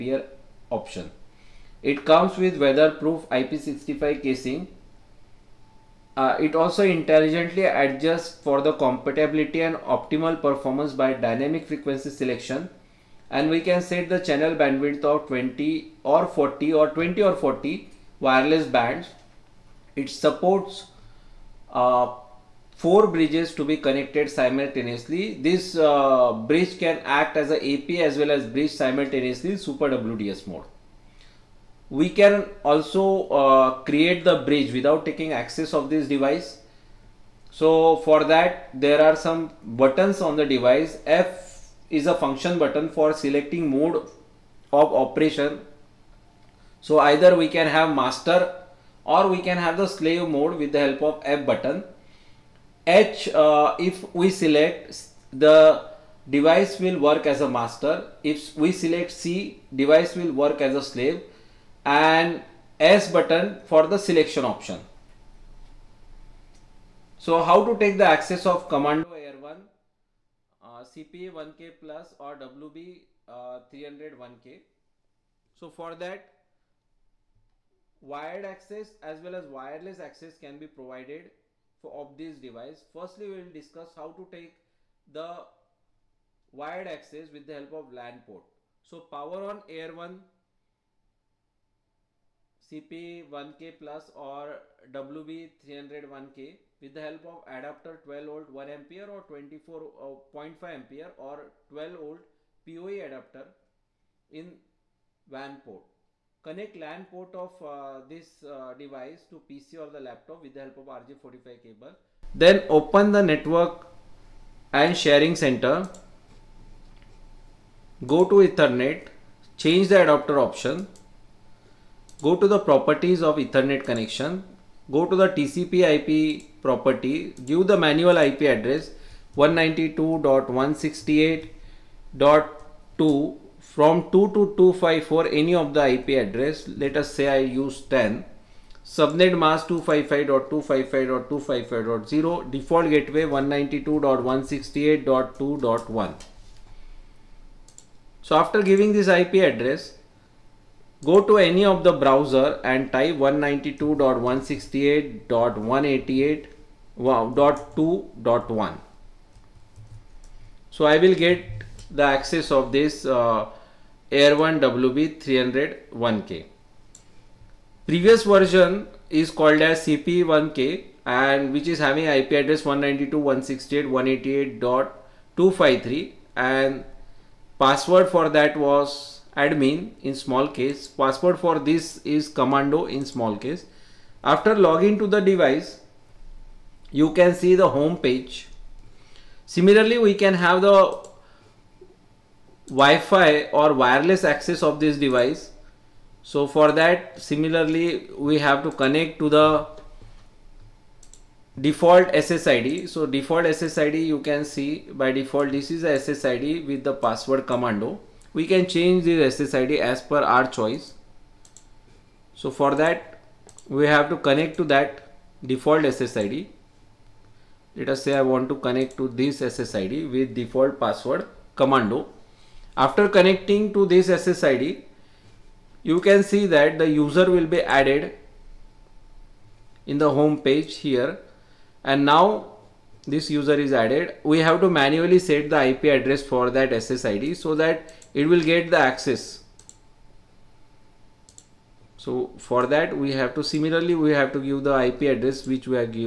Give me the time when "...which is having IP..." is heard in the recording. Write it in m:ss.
2:51.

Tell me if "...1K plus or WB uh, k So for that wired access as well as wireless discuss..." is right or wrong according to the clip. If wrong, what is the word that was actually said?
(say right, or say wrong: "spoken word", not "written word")
wrong: "access", not "discuss".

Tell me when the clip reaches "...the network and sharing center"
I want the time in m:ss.
1:53.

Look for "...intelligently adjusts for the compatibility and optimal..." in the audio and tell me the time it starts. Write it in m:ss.
0:06.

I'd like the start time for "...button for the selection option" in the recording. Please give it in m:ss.
1:03.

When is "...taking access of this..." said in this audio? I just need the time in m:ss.
0:35.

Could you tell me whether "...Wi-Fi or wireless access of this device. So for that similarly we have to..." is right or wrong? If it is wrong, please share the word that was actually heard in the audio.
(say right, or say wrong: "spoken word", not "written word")
right.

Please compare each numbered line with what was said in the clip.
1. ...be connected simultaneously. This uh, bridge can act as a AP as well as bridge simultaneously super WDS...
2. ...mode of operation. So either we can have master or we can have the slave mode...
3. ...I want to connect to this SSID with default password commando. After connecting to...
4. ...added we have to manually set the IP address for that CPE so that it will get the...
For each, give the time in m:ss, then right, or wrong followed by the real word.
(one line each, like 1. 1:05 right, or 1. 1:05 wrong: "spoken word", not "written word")
1. 0:23 right
2. 0:43 right
3. 3:38 right
4. 3:53 wrong: "SSID", not "CPE".